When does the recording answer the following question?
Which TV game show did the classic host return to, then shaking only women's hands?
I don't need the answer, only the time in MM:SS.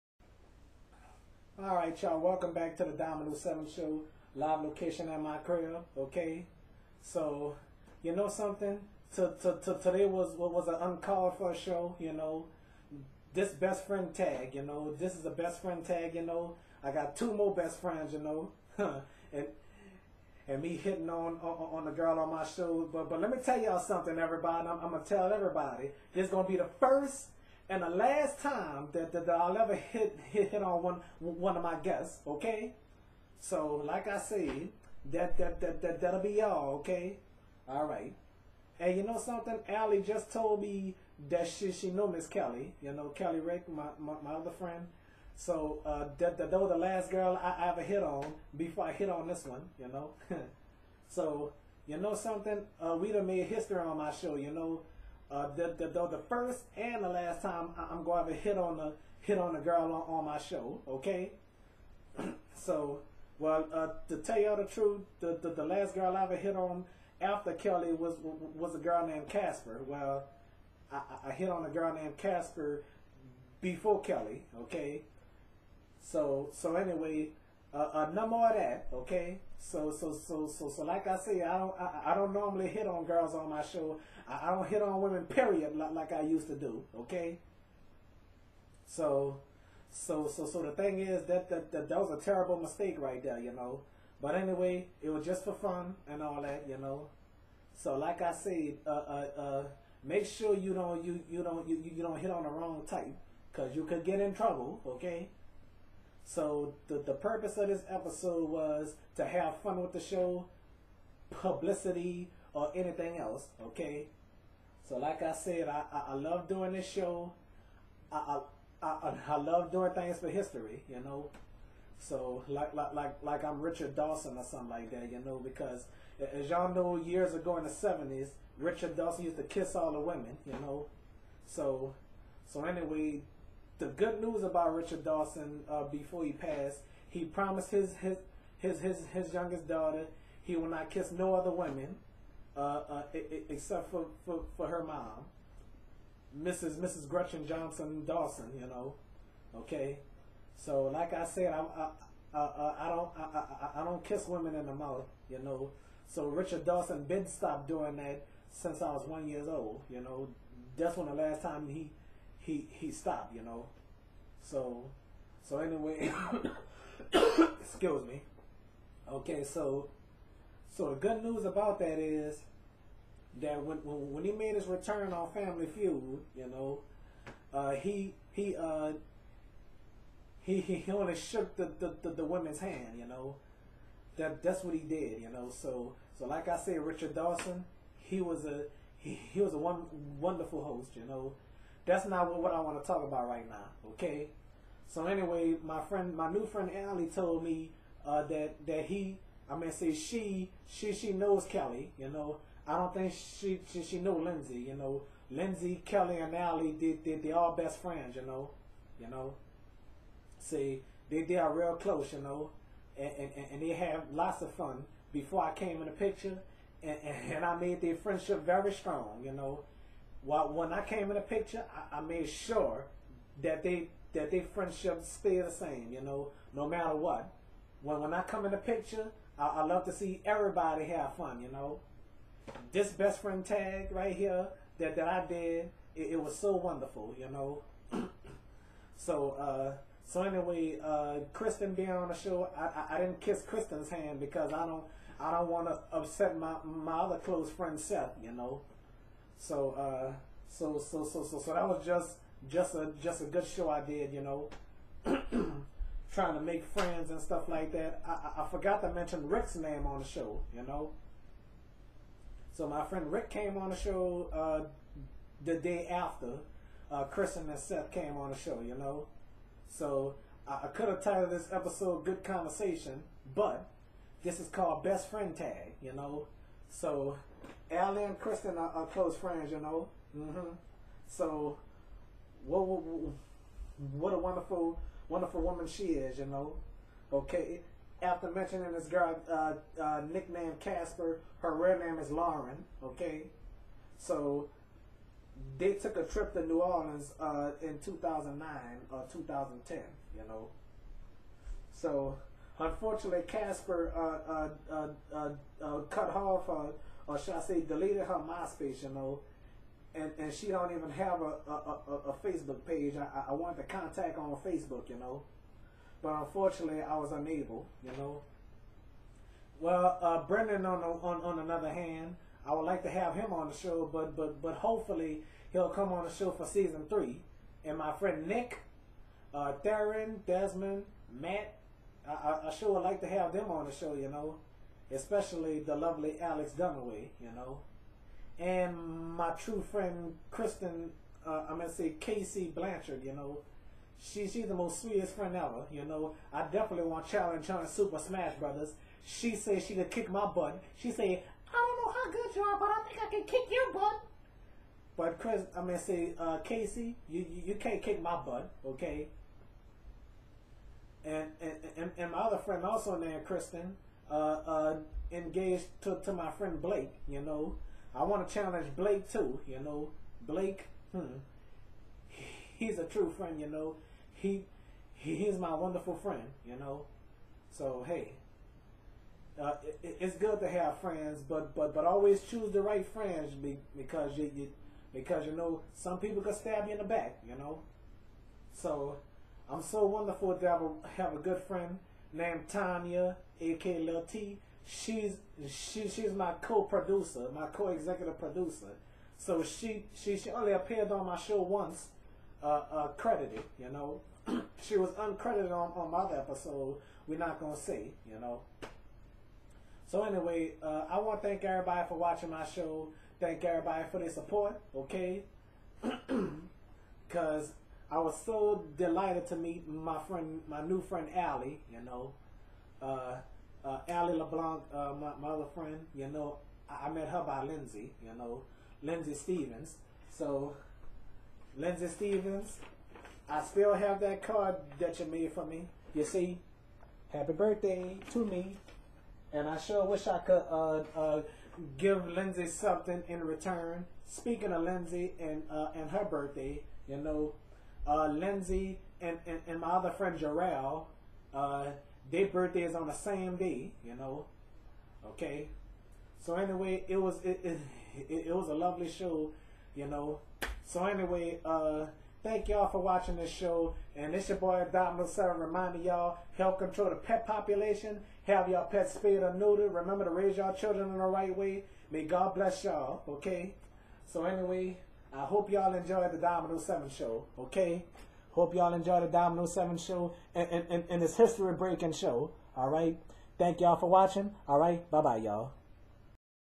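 02:55.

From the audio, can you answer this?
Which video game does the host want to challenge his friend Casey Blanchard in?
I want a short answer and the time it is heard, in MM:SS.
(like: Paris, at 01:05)
Super Smash Brothers, at 05:47.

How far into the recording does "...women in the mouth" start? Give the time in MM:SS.
02:34.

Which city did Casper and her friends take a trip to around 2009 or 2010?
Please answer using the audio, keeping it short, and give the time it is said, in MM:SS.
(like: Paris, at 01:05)
New Orleans, at 04:56.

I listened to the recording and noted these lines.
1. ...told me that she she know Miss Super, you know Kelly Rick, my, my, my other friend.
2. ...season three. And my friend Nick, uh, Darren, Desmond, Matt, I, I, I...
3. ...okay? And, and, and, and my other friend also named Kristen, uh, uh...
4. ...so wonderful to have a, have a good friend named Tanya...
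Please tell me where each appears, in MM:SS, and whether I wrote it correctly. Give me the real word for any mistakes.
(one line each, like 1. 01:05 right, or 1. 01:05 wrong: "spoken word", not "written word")
1. 00:40 wrong: "Kelly", not "Super"
2. 05:26 right
3. 05:58 right
4. 06:29 right.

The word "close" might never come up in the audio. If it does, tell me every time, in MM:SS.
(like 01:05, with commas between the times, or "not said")
03:31, 04:07, 04:38.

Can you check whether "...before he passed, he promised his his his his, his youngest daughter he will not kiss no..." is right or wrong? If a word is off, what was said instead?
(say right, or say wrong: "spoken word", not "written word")
right.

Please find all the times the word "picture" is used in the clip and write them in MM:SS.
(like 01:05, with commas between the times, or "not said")
03:35, 03:41, 03:48.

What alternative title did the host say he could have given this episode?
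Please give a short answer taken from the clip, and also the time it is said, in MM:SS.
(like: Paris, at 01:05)
Good Conversation, at 04:32.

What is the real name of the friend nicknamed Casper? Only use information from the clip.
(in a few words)
Lauren.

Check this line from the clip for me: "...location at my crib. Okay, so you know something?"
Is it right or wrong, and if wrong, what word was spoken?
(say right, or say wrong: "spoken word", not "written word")
right.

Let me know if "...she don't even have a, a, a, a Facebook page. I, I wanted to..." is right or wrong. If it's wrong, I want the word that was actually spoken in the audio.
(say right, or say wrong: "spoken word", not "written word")
right.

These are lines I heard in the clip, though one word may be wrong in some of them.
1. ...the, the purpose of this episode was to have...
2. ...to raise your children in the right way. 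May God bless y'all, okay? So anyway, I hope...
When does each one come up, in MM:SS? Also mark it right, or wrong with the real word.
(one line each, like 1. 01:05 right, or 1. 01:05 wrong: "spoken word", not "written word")
1. 01:46 right
2. 07:50 right.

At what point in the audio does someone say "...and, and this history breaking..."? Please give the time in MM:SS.
08:00.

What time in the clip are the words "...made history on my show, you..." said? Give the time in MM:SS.
00:53.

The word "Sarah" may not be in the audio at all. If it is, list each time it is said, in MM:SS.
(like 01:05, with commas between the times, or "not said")
07:45.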